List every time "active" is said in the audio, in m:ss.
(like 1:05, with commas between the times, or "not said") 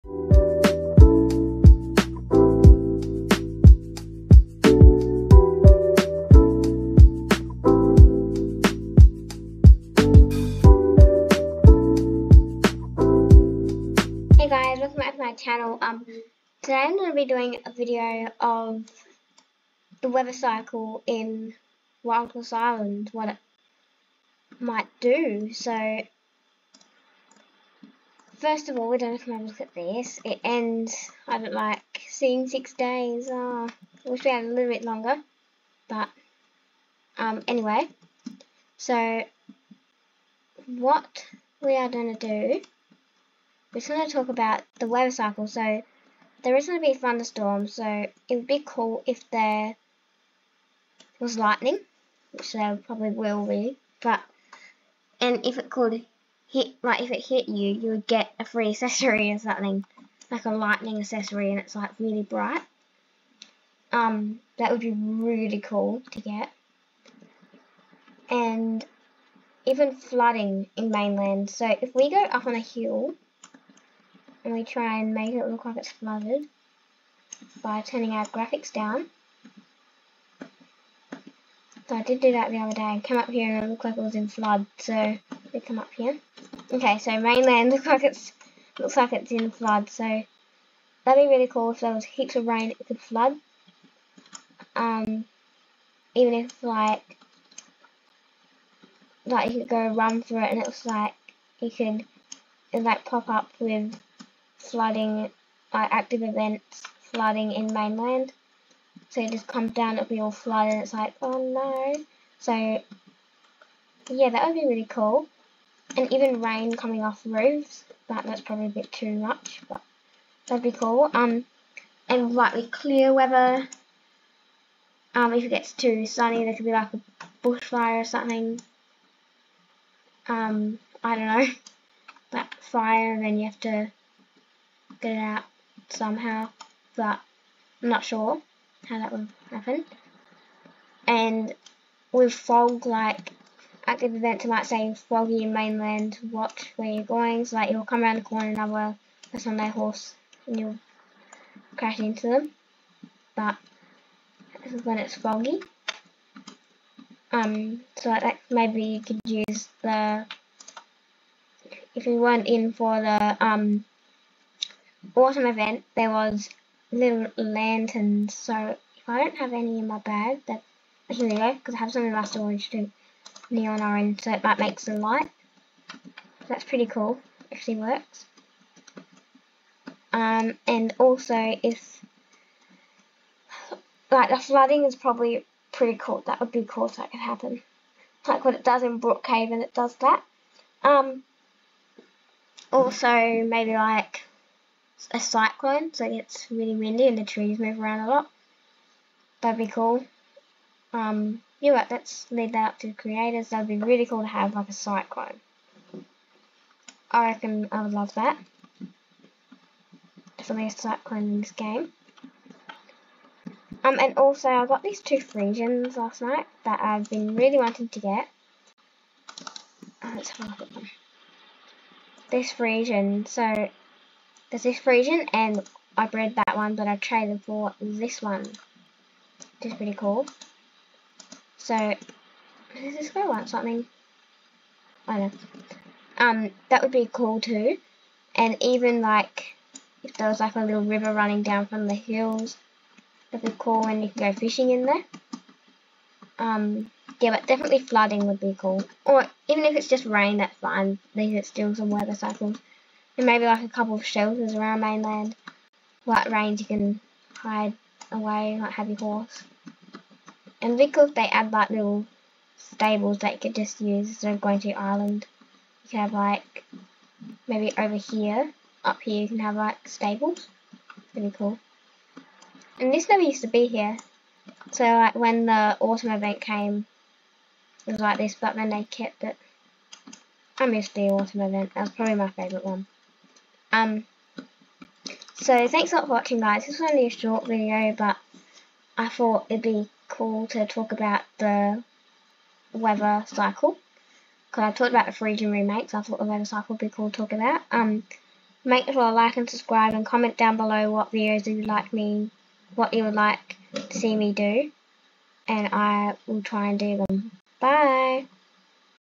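1:45, 2:23.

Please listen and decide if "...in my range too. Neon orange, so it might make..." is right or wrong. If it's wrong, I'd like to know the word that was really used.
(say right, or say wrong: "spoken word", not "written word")
wrong: "storage", not "range".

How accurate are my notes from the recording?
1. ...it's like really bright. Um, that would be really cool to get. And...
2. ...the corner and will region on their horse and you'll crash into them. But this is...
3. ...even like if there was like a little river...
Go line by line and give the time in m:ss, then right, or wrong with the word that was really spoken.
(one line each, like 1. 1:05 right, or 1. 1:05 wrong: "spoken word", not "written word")
1. 1:01 right
2. 2:28 wrong: "person", not "region"
3. 3:58 right.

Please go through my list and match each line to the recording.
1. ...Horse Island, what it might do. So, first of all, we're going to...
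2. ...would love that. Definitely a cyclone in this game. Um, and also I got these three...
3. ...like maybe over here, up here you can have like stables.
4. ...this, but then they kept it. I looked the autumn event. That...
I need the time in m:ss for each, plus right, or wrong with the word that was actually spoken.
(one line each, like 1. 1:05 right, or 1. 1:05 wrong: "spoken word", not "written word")
1. 0:22 right
2. 3:27 wrong: "two", not "three"
3. 4:26 right
4. 4:38 wrong: "missed", not "looked".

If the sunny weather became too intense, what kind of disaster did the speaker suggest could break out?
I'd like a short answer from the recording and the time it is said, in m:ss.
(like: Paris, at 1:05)
Bushfire, at 2:07.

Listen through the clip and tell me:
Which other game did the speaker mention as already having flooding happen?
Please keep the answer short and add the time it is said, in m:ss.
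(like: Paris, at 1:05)
Brookhaven, at 3:09.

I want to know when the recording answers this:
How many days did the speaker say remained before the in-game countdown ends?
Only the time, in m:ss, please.
0:32.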